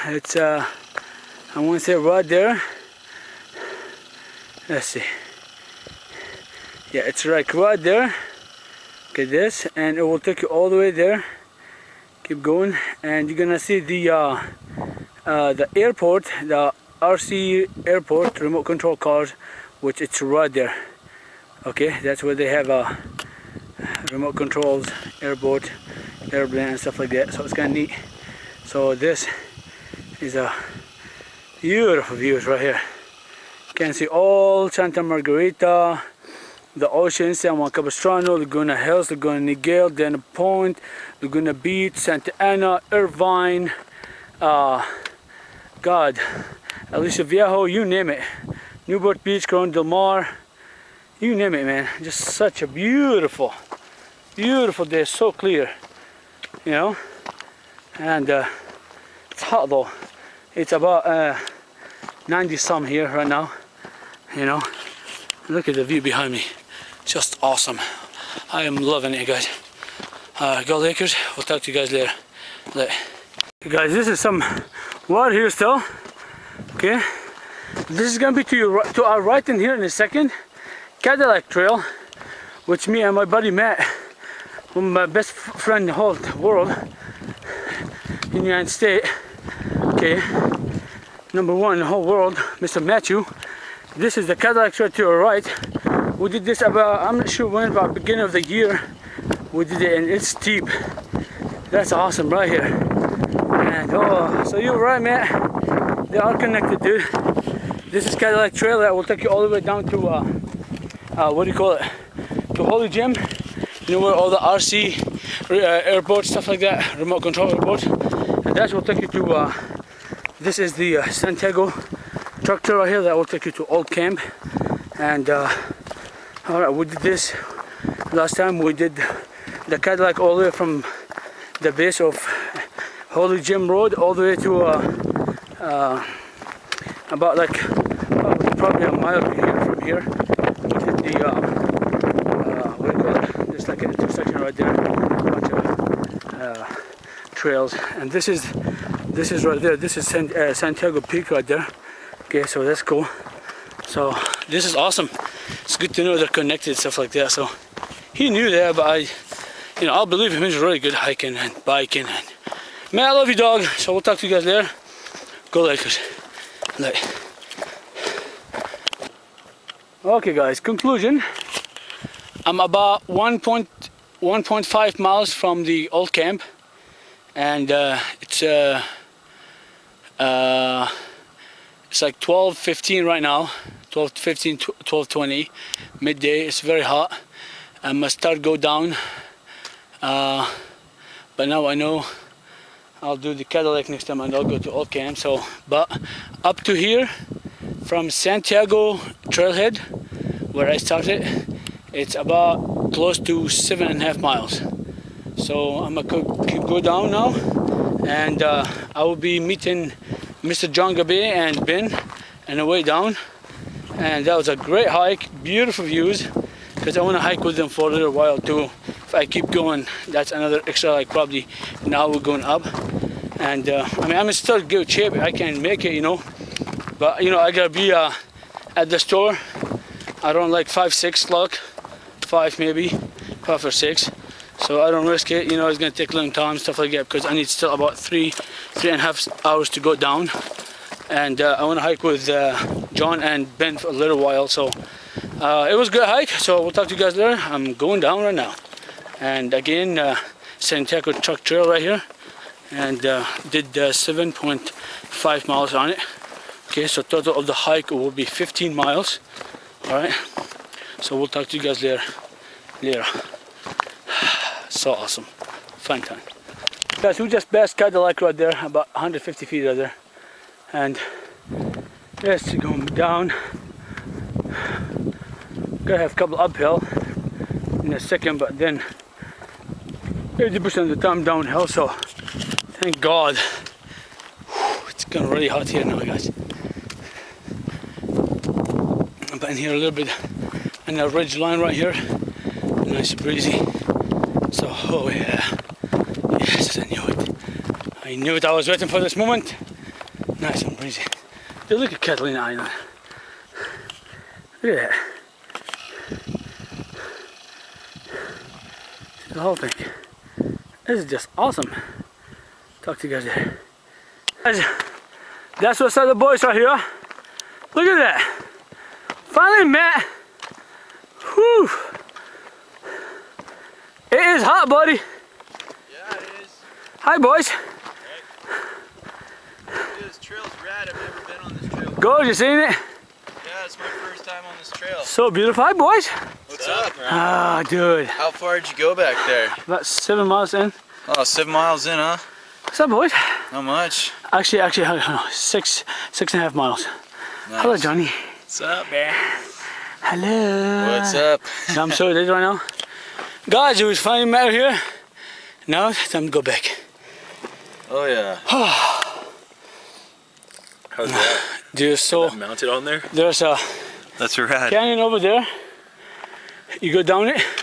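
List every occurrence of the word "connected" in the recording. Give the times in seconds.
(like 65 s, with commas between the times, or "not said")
106 s, 156 s.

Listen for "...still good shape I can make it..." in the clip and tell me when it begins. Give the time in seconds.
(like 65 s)
224 s.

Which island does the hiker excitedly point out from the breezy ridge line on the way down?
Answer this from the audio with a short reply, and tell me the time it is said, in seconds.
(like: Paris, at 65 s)
Catalina Island, at 302 s.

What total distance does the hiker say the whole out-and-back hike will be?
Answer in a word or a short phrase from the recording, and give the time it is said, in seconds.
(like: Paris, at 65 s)
15 miles, at 258 s.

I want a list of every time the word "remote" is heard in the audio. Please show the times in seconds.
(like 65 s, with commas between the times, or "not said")
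18 s, 24 s, 116 s.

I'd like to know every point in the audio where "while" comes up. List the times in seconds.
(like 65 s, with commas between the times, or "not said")
218 s, 244 s.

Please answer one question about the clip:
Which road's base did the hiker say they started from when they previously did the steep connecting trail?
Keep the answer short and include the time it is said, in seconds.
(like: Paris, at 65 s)
Holy Jim Road, at 133 s.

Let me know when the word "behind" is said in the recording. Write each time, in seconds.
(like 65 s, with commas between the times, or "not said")
66 s.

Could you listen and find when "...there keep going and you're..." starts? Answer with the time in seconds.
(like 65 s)
10 s.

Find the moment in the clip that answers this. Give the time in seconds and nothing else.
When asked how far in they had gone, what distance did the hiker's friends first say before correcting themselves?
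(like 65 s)
339 s.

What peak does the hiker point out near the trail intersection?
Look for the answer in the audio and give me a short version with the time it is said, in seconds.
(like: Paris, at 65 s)
Santiago Peak, at 150 s.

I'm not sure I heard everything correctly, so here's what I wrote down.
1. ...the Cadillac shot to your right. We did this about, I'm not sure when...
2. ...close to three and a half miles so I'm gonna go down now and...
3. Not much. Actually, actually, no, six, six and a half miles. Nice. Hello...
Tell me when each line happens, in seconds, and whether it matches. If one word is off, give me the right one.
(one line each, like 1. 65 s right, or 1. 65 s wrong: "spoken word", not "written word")
1. 94 s right
2. 202 s wrong: "seven", not "three"
3. 343 s right.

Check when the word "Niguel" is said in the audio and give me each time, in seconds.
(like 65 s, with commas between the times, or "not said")
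39 s.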